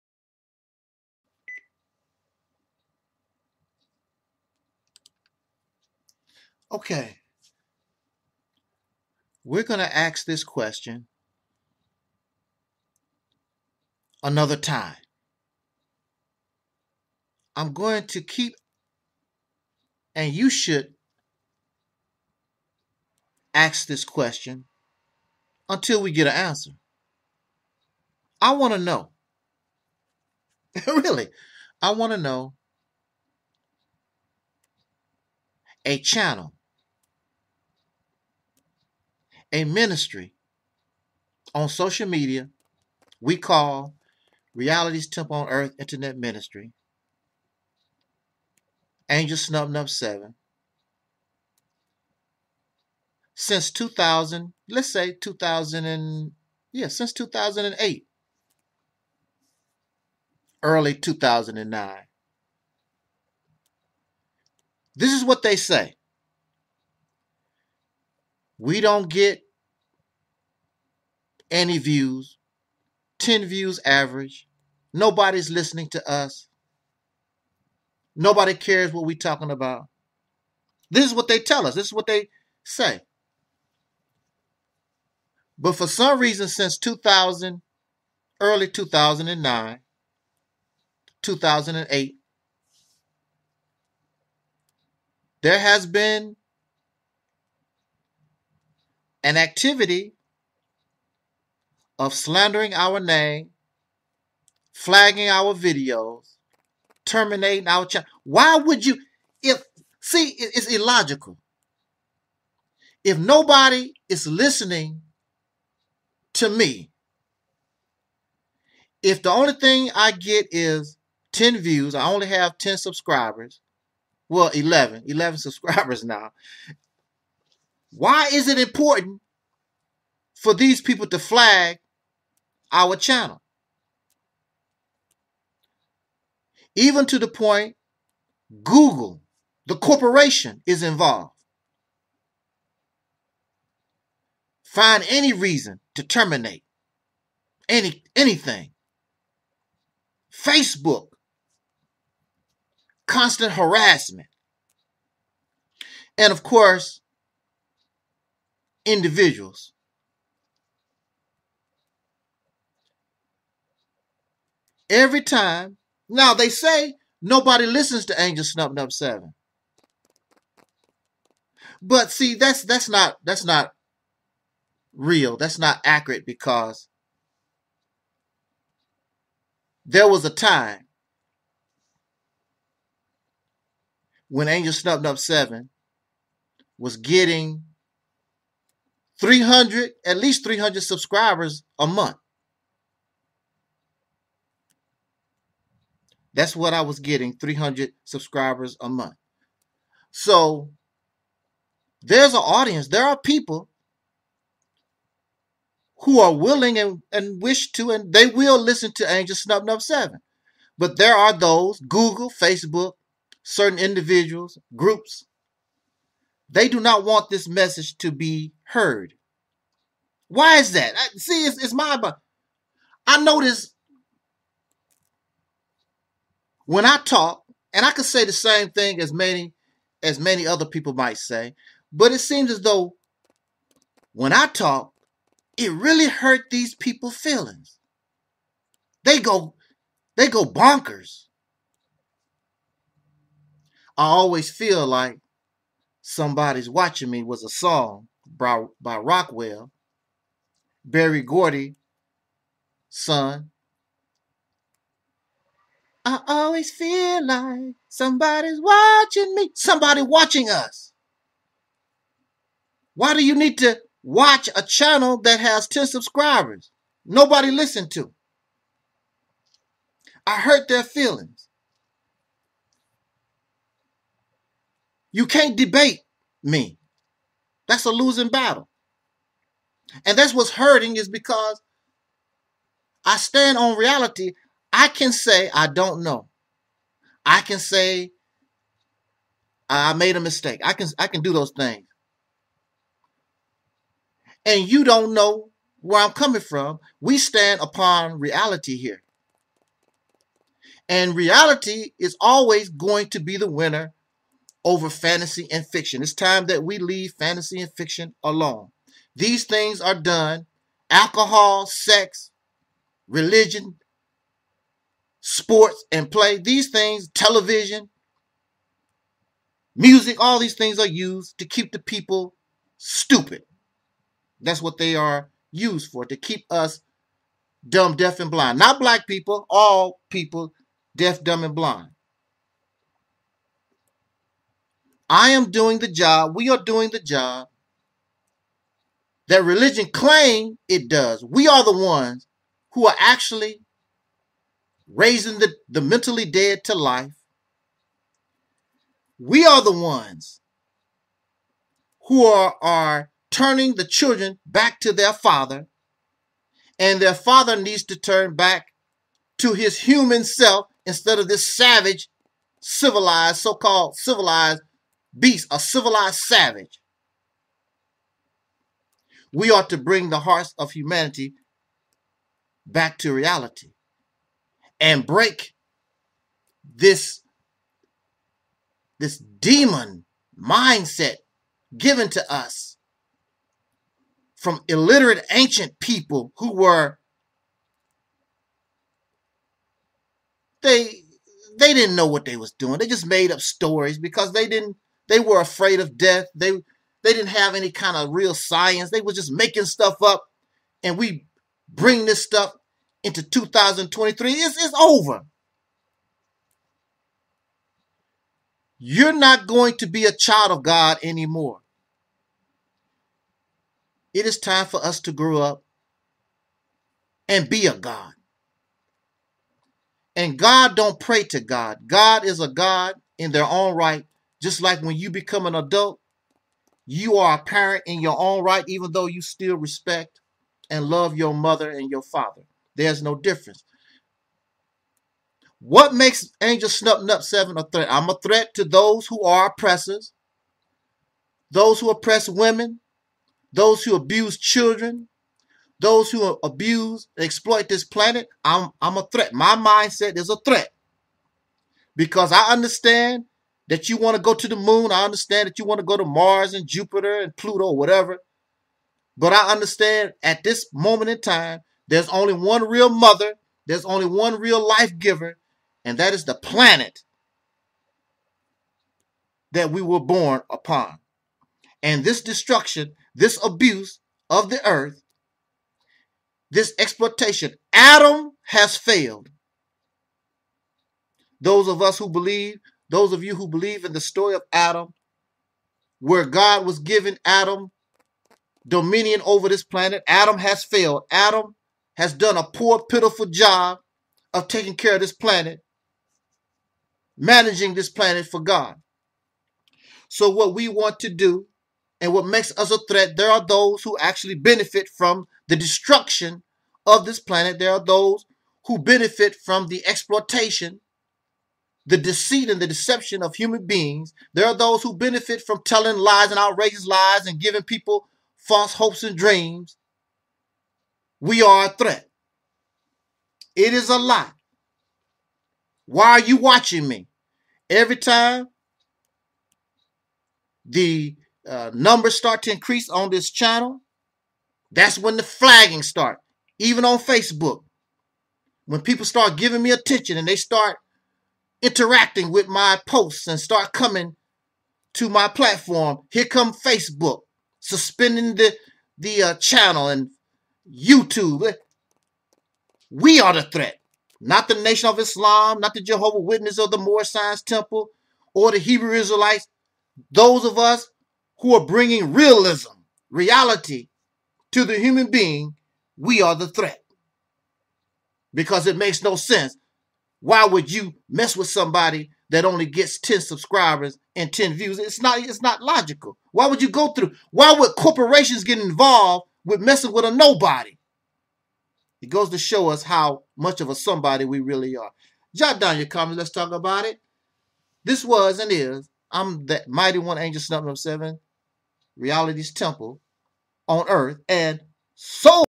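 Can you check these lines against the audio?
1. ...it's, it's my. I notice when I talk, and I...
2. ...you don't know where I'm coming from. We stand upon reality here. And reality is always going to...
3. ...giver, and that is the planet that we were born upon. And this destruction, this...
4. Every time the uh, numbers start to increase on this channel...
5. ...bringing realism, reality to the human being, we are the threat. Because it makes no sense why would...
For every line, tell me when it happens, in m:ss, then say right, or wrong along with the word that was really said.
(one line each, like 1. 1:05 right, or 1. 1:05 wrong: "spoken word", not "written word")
1. 3:41 right
2. 4:54 right
3. 7:44 right
4. 8:47 right
5. 9:21 right.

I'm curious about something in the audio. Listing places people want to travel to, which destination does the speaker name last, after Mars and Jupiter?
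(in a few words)
Pluto.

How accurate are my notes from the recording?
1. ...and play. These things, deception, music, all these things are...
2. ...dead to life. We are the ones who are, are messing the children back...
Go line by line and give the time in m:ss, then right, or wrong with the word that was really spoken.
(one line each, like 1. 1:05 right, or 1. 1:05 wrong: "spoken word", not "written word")
1. 5:15 wrong: "television", not "deception"
2. 5:46 wrong: "turning", not "messing".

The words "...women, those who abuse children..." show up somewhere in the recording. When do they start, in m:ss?
7:22.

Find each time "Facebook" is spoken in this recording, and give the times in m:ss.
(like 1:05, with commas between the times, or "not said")
2:30, 3:32, 8:56, 9:06.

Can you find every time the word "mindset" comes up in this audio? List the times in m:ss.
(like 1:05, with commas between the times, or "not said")
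6:20, 7:29.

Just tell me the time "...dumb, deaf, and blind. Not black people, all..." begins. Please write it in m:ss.
5:27.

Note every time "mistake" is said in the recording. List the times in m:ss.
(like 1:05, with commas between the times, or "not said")
4:50.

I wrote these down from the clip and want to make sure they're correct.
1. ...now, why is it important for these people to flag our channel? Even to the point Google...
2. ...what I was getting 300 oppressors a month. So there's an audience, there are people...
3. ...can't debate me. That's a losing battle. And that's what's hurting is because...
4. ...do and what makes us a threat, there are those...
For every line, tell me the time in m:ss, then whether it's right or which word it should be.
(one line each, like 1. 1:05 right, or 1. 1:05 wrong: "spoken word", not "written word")
1. 2:06 right
2. 3:16 wrong: "subscribers", not "oppressors"
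3. 4:35 right
4. 8:21 right.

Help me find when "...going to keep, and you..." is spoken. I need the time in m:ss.
0:17.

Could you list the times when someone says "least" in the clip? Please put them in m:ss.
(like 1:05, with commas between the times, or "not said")
3:10.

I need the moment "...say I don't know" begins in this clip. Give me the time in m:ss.
4:45.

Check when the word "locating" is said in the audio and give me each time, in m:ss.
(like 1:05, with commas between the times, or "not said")
not said.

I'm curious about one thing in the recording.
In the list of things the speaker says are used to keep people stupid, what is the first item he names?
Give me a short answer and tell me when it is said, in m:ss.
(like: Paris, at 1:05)
alcohol, at 5:10.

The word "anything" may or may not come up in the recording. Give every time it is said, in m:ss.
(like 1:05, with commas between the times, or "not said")
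2:28.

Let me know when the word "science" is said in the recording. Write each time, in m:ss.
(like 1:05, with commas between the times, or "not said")
6:38, 9:17.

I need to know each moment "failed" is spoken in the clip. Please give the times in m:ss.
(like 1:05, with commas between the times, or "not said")
7:58, 8:10.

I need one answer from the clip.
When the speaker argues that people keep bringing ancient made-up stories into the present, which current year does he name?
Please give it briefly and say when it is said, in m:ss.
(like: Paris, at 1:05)
2023, at 6:43.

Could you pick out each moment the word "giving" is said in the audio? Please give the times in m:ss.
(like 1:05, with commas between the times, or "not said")
8:06, 8:37, 8:59.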